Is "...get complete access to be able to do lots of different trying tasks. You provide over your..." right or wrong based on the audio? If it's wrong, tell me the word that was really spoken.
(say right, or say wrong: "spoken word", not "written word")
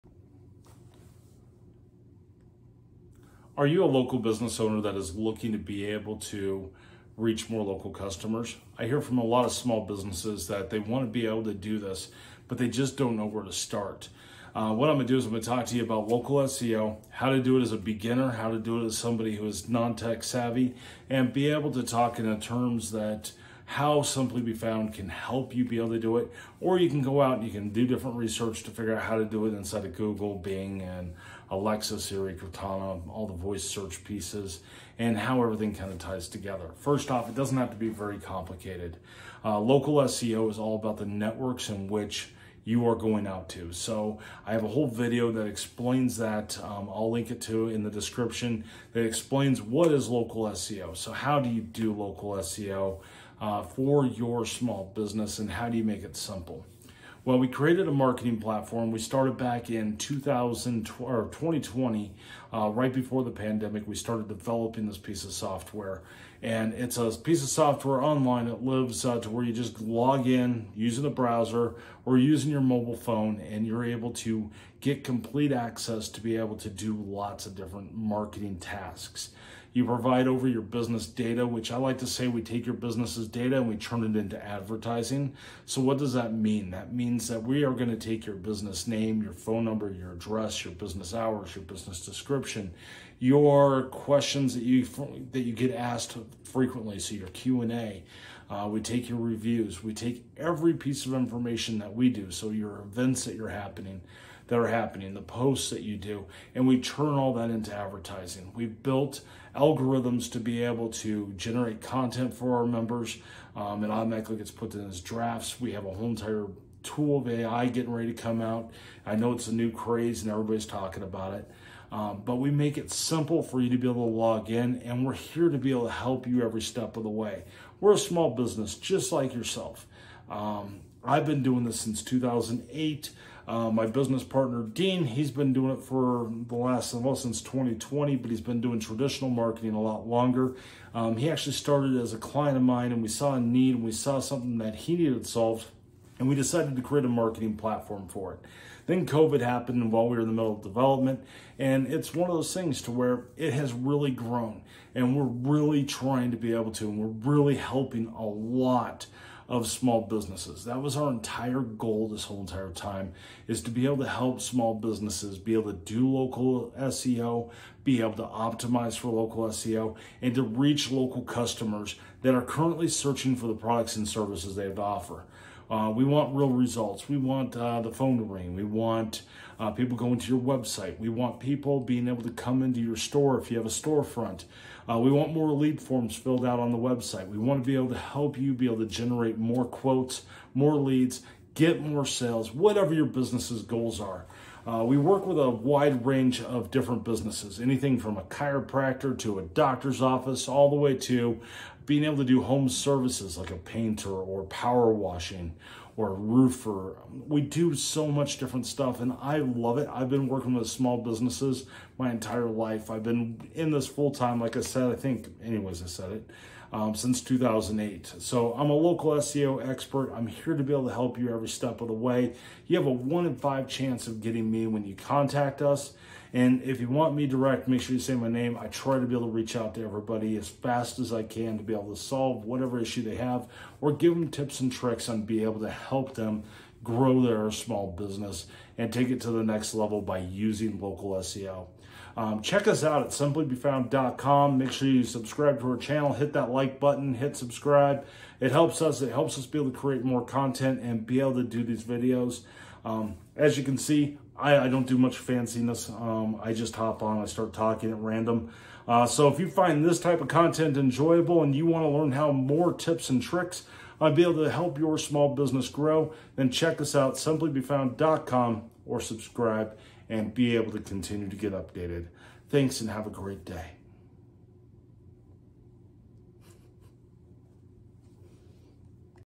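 wrong: "marketing", not "trying".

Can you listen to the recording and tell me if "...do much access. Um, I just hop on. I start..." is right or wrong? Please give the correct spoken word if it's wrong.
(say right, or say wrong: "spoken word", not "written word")
wrong: "fanciness", not "access".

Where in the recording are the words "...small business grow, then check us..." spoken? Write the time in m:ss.
4:24.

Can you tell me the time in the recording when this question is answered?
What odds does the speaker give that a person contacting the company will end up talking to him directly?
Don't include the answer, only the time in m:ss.
3:42.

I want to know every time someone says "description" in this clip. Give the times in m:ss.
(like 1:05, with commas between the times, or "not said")
0:47, 1:32.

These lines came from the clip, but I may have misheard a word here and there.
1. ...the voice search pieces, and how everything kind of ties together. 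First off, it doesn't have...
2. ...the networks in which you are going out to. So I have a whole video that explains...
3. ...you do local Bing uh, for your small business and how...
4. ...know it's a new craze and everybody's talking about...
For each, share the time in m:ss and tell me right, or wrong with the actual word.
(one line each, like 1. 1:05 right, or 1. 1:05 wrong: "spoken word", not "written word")
1. 0:33 right
2. 0:40 right
3. 0:51 wrong: "SEO", not "Bing"
4. 1:59 right.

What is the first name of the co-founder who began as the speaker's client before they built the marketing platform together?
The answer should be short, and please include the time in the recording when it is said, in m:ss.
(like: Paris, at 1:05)
Dean, at 2:14.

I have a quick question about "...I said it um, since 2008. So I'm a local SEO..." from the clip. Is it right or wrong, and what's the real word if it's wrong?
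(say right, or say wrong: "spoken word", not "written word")
right.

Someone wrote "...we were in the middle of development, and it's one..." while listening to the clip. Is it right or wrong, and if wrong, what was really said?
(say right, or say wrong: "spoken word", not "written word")
right.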